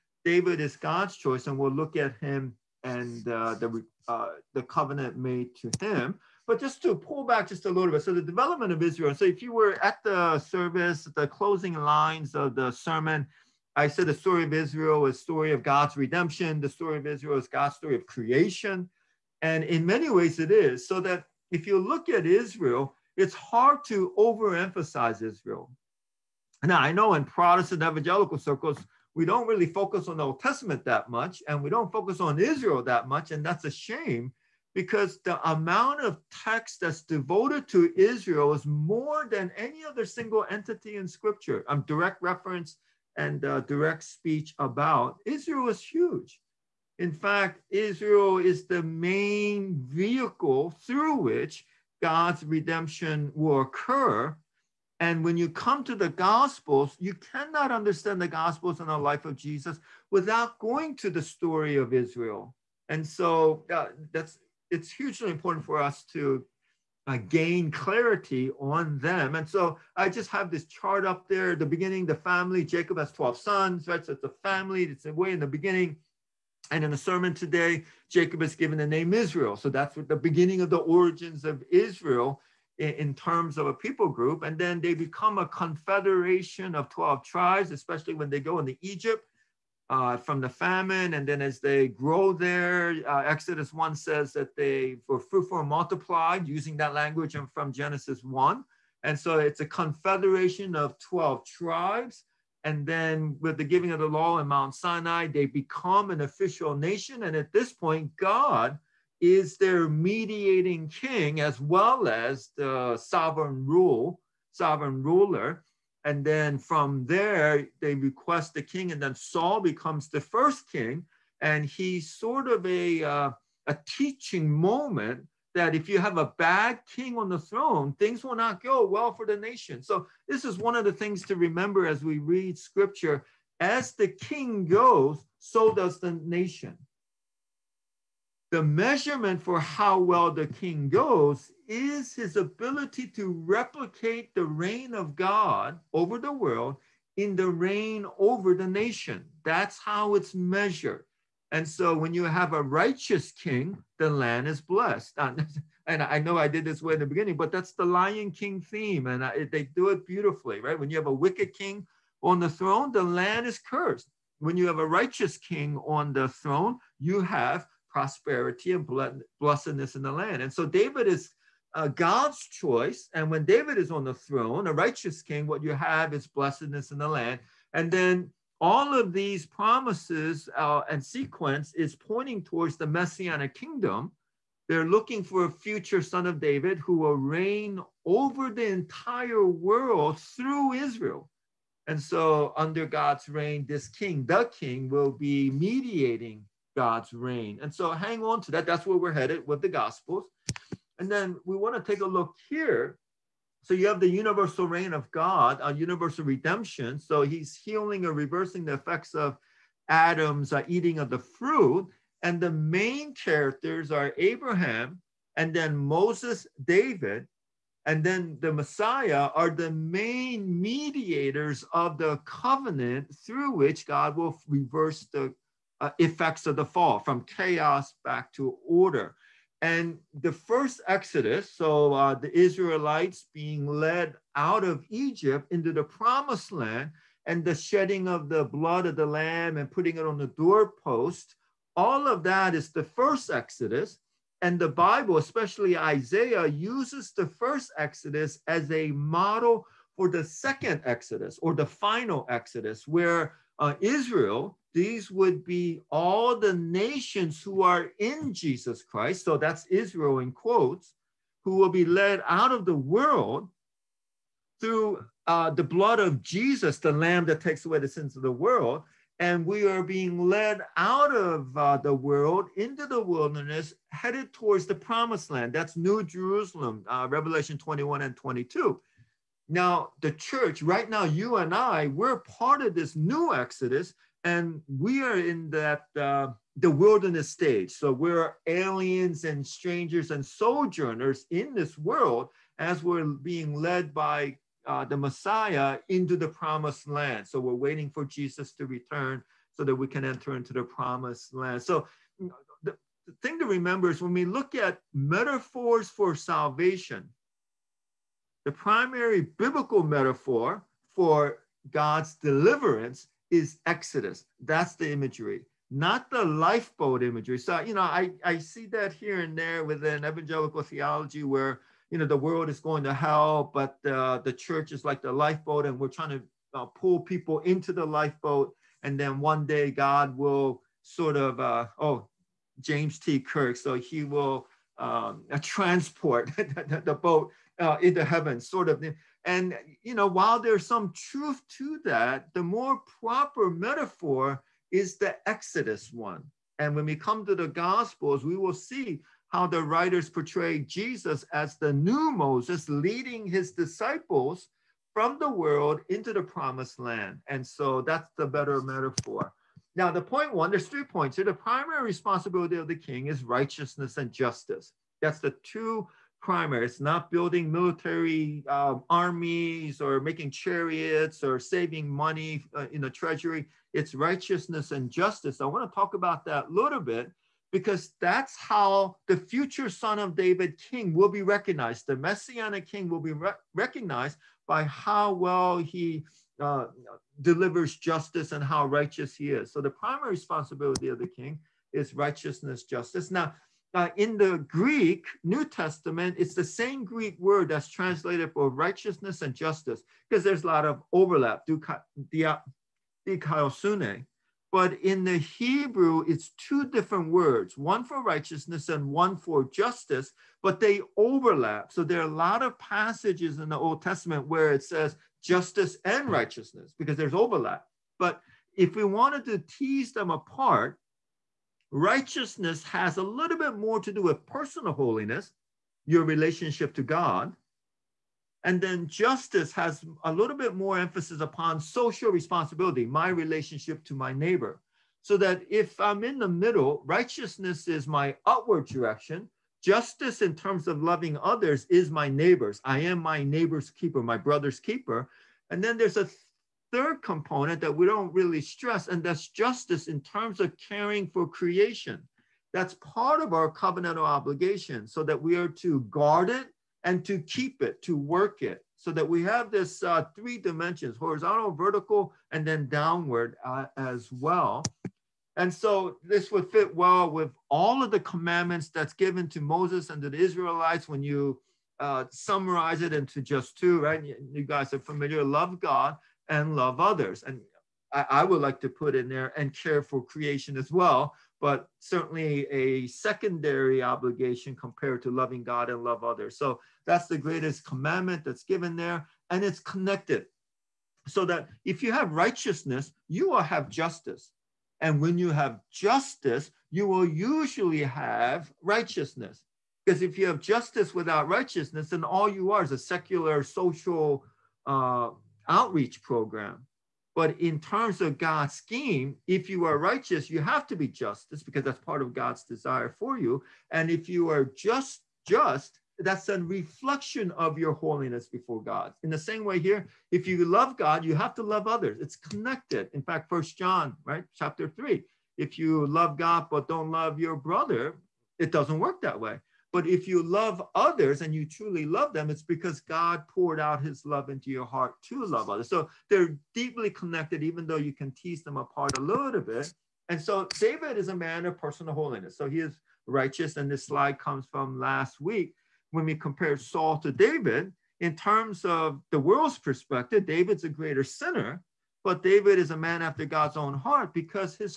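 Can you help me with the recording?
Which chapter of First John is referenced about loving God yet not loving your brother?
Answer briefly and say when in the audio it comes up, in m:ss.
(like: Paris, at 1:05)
3, at 8:44.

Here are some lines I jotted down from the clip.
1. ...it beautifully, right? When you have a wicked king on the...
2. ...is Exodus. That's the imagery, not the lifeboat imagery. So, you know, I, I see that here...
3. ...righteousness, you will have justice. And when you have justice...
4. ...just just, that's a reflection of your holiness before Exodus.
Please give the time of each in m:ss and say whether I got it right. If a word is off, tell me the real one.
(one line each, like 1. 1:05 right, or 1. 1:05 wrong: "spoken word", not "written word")
1. 2:39 right
2. 5:13 right
3. 8:12 right
4. 8:34 wrong: "God", not "Exodus".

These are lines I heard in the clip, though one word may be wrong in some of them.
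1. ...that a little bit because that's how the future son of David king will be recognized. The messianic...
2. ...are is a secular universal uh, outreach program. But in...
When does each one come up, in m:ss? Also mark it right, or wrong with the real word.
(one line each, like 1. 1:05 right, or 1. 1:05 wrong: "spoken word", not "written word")
1. 6:16 right
2. 8:22 wrong: "social", not "universal".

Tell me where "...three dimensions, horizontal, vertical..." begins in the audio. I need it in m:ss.
7:40.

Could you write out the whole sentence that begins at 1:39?
And so it's a confederation of 12 tribes.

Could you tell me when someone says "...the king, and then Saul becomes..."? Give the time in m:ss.
1:58.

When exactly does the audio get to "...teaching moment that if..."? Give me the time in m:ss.
2:03.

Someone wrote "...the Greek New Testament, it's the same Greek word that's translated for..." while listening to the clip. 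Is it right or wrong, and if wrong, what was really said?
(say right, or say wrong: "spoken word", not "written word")
right.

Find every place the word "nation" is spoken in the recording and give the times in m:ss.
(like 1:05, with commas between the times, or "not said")
1:46, 2:09, 2:16, 2:28, 4:16.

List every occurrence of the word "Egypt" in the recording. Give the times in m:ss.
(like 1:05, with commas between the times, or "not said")
1:28, 3:54.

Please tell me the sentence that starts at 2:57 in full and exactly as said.
And then all of these promises uh, and sequence is pointing towards the messianic kingdom.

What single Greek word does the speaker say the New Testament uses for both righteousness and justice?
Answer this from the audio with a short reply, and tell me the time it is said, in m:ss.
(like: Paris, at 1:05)
dikaiosune, at 6:43.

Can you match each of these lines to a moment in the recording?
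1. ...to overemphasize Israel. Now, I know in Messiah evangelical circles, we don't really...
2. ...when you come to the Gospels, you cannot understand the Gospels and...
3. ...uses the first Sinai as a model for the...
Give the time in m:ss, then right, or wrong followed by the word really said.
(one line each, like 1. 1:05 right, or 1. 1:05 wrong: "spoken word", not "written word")
1. 0:23 wrong: "Protestant", not "Messiah"
2. 0:55 right
3. 4:06 wrong: "Exodus", not "Sinai".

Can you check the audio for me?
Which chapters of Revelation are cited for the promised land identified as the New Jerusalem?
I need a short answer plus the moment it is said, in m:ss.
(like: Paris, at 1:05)
21 and 22, at 4:37.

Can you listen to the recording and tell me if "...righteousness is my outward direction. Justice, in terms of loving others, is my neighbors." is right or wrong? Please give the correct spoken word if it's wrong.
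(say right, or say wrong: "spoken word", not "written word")
right.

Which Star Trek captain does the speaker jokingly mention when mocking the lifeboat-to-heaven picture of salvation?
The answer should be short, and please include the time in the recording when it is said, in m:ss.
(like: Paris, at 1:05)
James T. Kirk, at 5:32.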